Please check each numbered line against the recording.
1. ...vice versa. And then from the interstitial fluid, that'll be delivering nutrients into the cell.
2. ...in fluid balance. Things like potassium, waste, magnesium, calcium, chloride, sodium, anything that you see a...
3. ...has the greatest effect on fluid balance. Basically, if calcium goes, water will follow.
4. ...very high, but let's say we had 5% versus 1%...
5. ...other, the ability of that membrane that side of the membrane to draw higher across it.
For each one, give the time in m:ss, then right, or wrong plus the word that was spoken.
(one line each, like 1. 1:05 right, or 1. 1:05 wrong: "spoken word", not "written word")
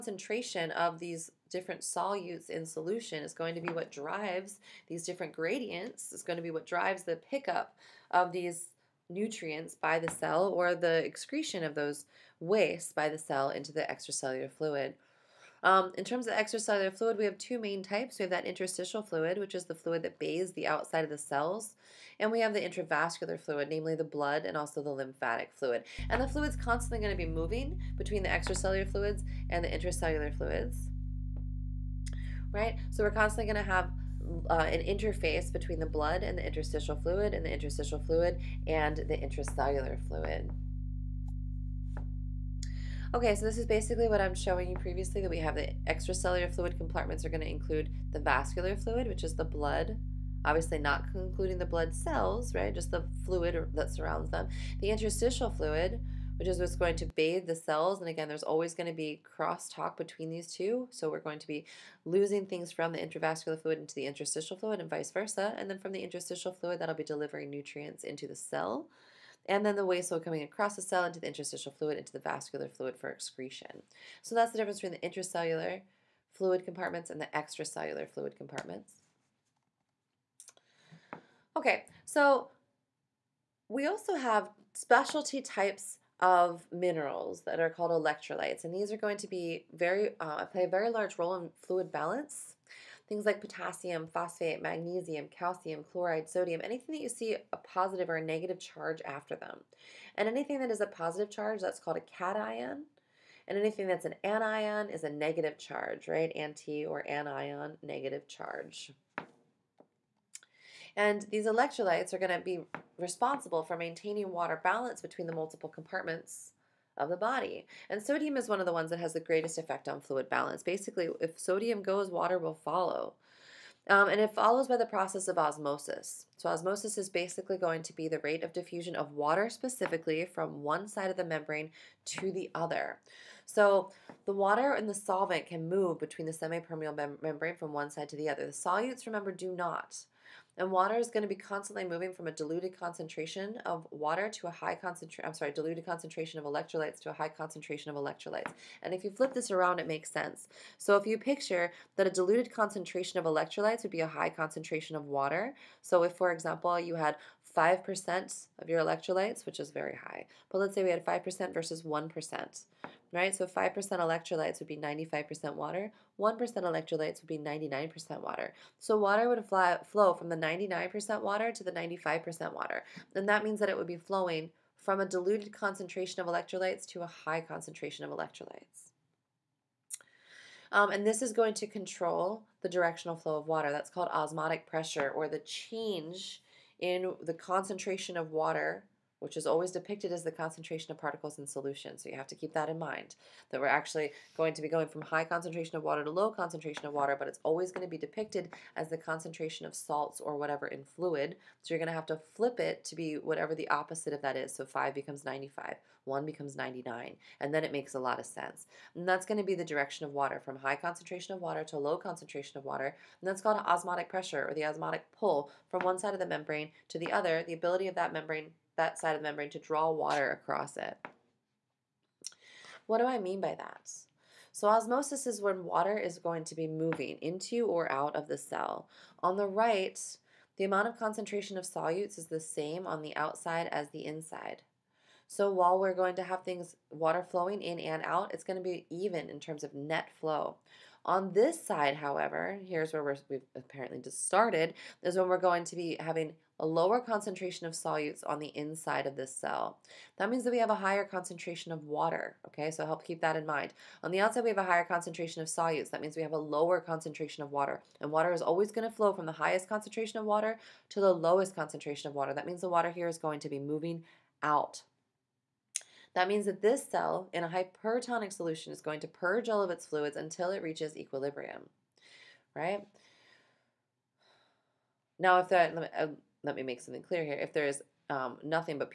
1. 1:04 right
2. 1:31 wrong: "phosphate", not "waste"
3. 1:58 wrong: "sodium", not "calcium"
4. 2:39 right
5. 3:37 wrong: "water", not "higher".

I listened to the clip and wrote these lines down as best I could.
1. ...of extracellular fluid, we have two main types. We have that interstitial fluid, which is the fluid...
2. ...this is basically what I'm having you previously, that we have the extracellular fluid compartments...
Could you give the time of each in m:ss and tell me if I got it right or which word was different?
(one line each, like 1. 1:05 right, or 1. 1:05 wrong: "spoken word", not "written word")
1. 0:16 right
2. 0:43 wrong: "showing", not "having".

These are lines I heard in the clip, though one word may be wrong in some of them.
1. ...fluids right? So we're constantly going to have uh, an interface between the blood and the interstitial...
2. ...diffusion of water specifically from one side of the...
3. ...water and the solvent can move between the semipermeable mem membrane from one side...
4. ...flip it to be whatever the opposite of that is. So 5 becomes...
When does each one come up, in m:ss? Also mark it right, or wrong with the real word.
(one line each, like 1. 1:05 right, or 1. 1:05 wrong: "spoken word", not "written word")
1. 0:30 right
2. 2:08 right
3. 2:14 right
4. 3:22 right.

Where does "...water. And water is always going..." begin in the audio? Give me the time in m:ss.
4:17.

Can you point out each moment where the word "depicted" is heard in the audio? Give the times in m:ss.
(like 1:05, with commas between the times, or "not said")
3:09, 3:17.